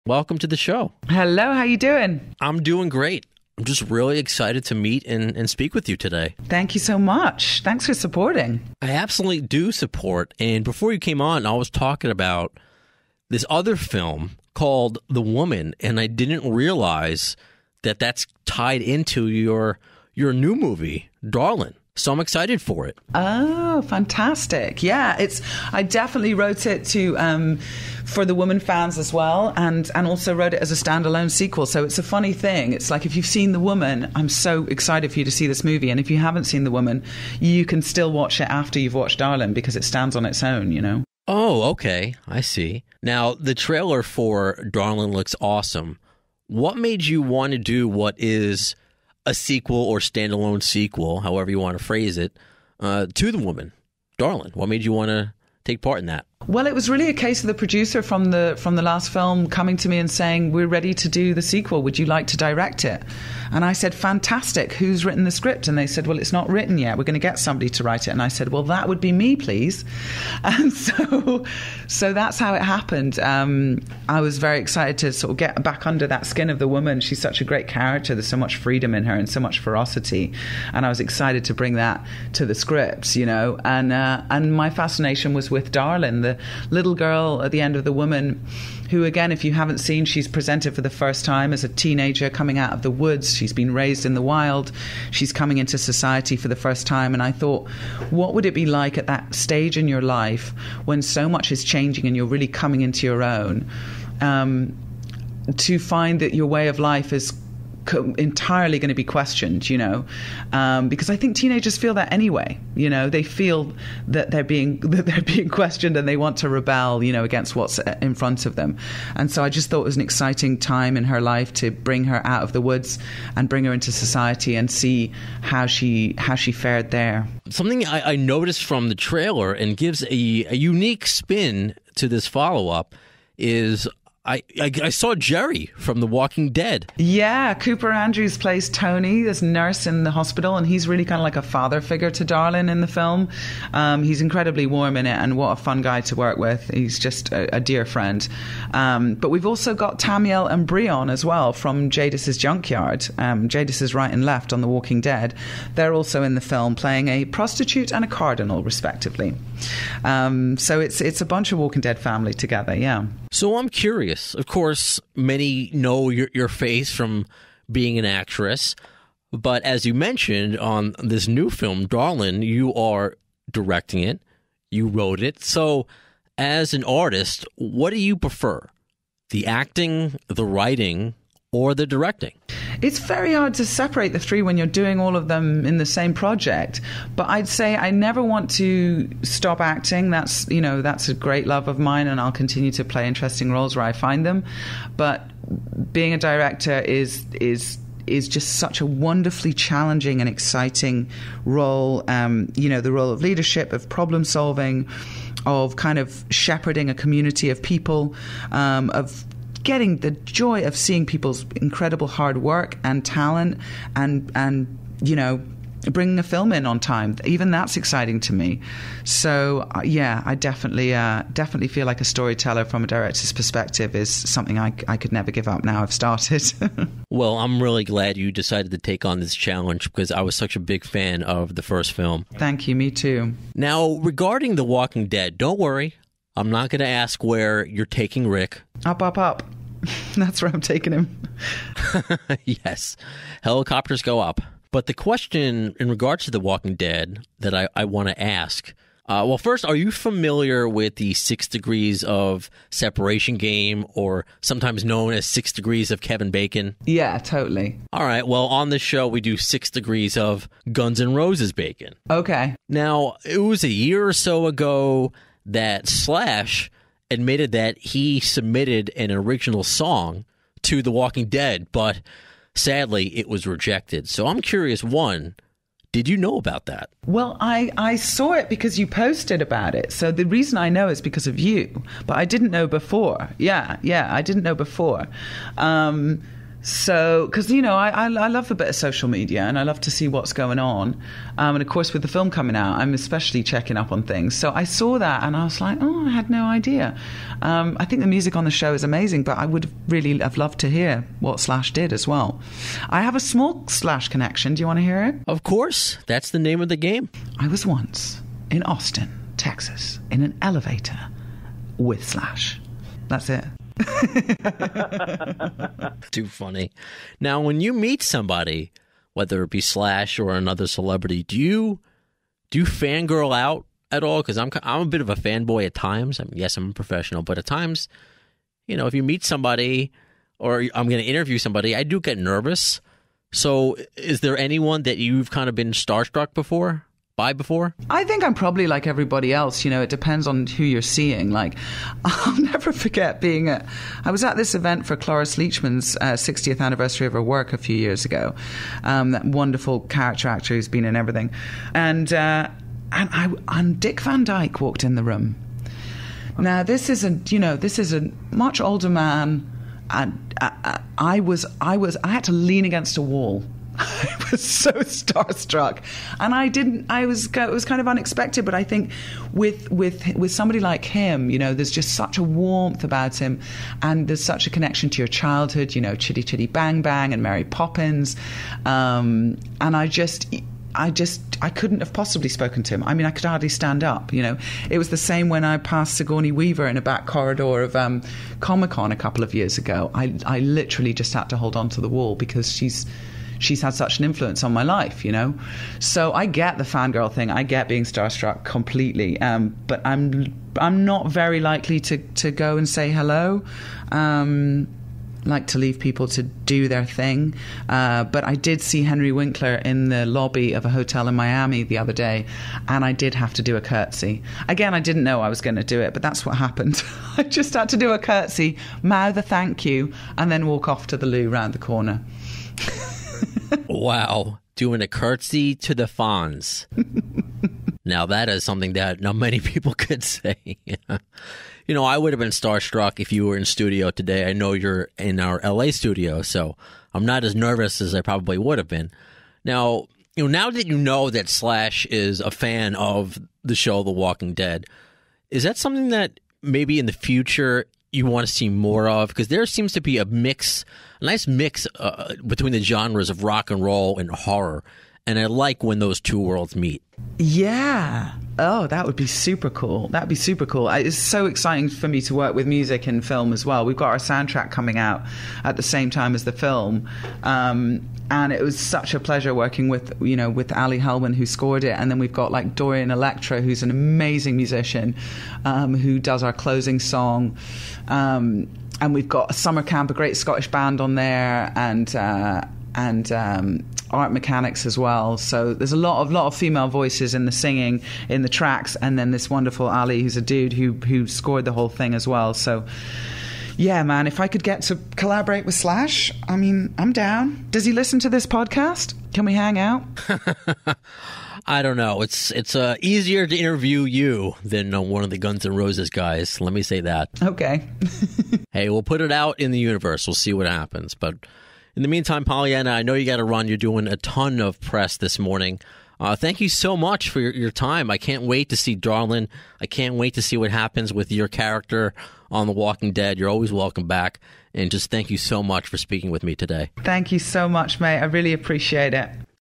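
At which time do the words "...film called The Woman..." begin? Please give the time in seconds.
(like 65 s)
13 s.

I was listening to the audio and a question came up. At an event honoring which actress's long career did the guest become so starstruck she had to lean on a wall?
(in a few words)
Cloris Leachman.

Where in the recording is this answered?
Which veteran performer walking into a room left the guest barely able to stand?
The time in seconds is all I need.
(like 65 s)
353 s.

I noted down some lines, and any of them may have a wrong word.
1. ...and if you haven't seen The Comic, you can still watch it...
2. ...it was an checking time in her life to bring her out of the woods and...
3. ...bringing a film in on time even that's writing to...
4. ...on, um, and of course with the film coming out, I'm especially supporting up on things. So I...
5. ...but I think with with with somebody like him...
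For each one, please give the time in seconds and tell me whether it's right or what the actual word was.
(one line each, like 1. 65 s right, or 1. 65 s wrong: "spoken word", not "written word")
1. 35 s wrong: "Woman", not "Comic"
2. 119 s wrong: "exciting", not "checking"
3. 215 s wrong: "exciting", not "writing"
4. 290 s wrong: "checking", not "supporting"
5. 368 s right.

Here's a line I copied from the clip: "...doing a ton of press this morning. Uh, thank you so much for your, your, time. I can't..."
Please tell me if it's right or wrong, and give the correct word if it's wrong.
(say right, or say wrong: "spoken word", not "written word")
right.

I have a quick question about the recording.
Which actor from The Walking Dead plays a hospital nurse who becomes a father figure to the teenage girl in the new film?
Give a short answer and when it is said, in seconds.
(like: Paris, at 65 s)
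Cooper Andrews, at 137 s.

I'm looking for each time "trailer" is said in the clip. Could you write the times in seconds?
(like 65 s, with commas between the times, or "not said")
43 s, 128 s.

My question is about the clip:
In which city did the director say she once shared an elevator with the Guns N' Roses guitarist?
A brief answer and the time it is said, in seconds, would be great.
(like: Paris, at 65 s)
Austin, Texas, at 308 s.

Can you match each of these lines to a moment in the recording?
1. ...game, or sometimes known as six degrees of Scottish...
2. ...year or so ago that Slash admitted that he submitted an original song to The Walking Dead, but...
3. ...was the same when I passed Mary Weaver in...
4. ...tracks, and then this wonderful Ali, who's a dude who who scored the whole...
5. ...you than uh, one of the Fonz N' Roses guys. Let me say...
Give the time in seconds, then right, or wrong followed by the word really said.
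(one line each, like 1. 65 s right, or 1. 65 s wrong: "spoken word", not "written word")
1. 253 s wrong: "Kevin", not "Scottish"
2. 263 s right
3. 384 s wrong: "Sigourney", not "Mary"
4. 488 s right
5. 503 s wrong: "Guns", not "Fonz".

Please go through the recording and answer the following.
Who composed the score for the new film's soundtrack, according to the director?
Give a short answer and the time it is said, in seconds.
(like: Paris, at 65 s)
Ali Helnwein, at 470 s.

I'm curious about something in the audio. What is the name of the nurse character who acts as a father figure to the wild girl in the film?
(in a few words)
Tony.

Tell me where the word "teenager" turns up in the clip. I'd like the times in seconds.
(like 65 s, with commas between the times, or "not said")
91 s, 111 s.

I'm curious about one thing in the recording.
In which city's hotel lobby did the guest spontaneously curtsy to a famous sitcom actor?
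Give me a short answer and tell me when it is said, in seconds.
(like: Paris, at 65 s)
Miami, at 411 s.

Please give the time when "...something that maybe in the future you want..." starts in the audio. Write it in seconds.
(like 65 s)
445 s.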